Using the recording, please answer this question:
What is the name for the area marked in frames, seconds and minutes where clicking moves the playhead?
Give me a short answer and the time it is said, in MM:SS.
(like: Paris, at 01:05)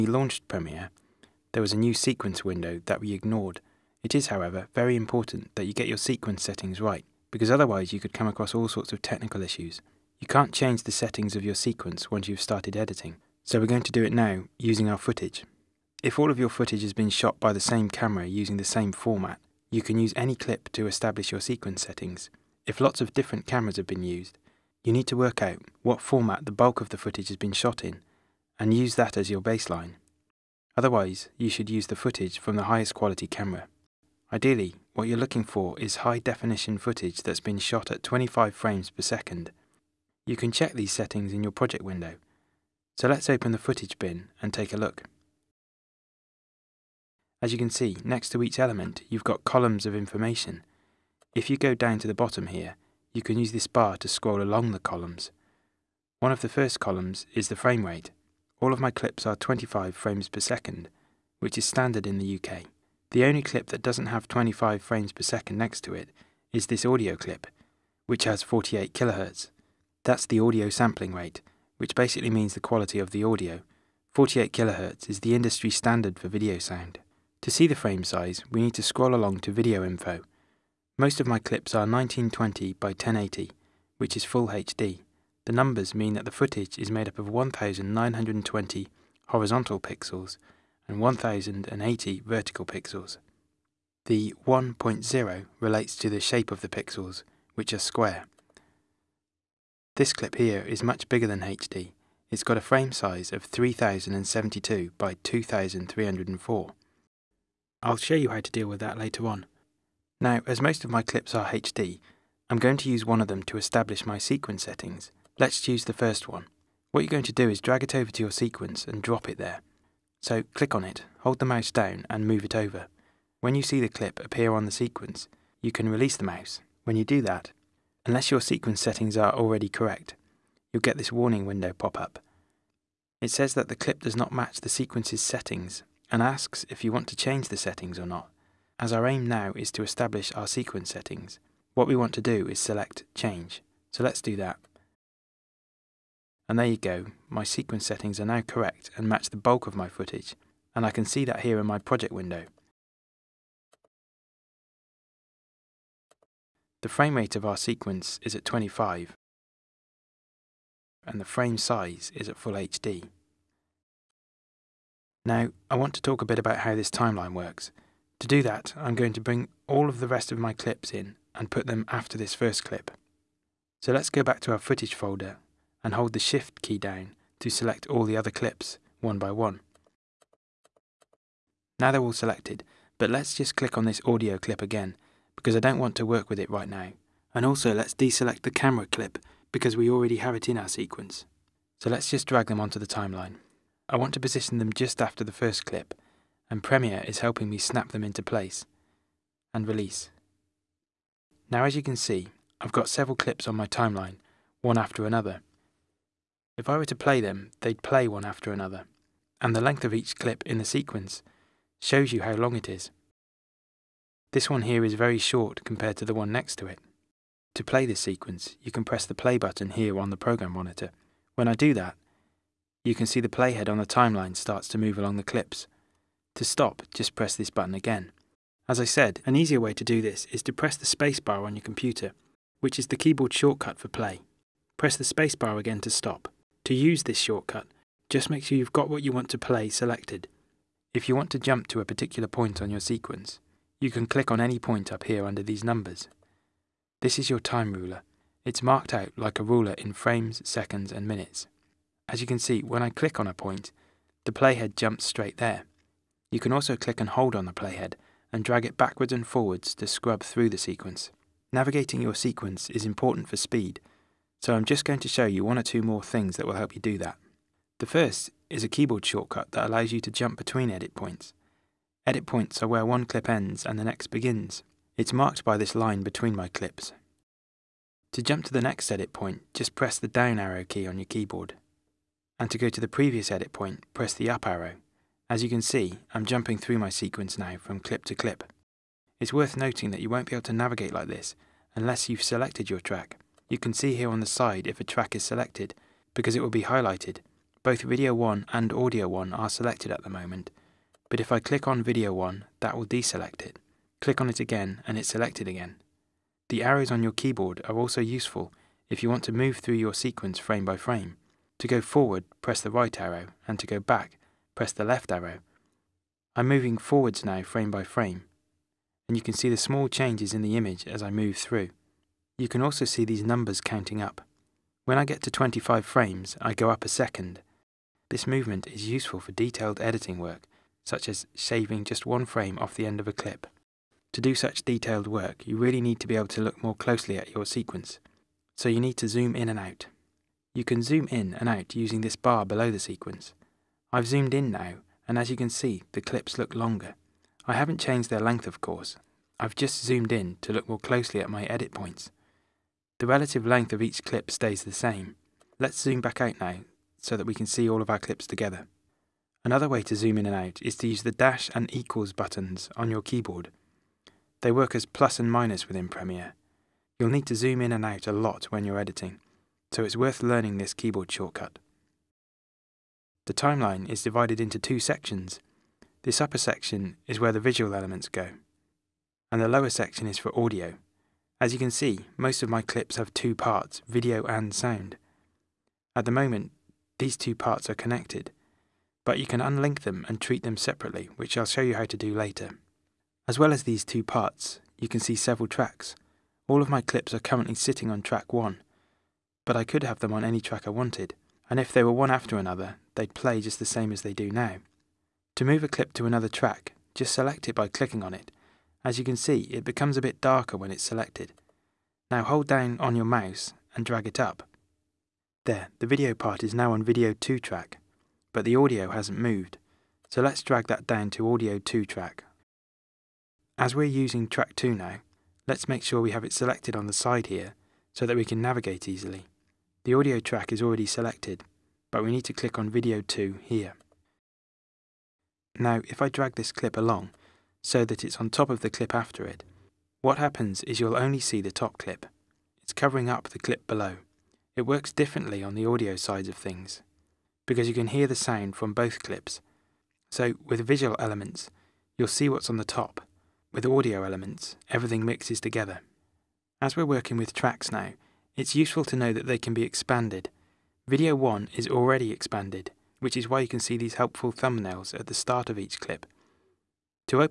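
time ruler, at 04:07.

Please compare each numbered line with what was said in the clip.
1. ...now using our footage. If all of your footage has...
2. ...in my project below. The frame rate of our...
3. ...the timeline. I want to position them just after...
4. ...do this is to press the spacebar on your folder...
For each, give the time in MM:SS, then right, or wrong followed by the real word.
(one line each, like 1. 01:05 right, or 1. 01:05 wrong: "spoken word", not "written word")
1. 00:14 right
2. 02:31 wrong: "window", not "below"
3. 03:12 right
4. 03:49 wrong: "computer", not "folder".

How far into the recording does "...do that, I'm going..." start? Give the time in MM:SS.
02:48.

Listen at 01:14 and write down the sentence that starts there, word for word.
48 kHz is the industry standard for video sound.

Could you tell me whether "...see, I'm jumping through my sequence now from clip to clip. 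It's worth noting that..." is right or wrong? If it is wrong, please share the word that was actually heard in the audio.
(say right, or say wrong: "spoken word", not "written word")
right.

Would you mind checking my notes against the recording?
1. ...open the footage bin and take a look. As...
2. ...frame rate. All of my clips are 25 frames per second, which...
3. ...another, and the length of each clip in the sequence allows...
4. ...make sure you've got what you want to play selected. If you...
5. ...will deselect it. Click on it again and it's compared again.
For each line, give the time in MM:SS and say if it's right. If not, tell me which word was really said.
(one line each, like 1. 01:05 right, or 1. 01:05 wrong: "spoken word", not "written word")
1. 00:43 right
2. 00:57 right
3. 03:28 wrong: "shows", not "allows"
4. 03:58 right
5. 05:02 wrong: "selected", not "compared".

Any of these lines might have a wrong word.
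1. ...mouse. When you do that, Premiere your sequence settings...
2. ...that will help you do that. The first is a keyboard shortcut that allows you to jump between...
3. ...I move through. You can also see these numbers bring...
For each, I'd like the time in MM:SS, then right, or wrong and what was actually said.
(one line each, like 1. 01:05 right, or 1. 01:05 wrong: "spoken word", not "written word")
1. 02:06 wrong: "Unless", not "Premiere"
2. 04:26 right
3. 05:21 wrong: "counting", not "bring".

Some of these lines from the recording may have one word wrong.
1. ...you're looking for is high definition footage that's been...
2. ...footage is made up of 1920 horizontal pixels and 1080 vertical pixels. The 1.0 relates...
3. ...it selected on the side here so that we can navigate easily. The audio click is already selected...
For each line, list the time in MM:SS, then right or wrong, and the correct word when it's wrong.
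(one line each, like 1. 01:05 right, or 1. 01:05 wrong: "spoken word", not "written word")
1. 00:35 right
2. 01:26 right
3. 07:06 wrong: "track", not "click".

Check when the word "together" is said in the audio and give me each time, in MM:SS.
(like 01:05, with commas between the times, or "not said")
05:58, 07:35.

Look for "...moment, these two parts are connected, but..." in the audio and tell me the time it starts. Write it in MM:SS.
06:26.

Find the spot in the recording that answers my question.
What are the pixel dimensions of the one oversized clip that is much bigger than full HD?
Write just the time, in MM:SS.
01:43.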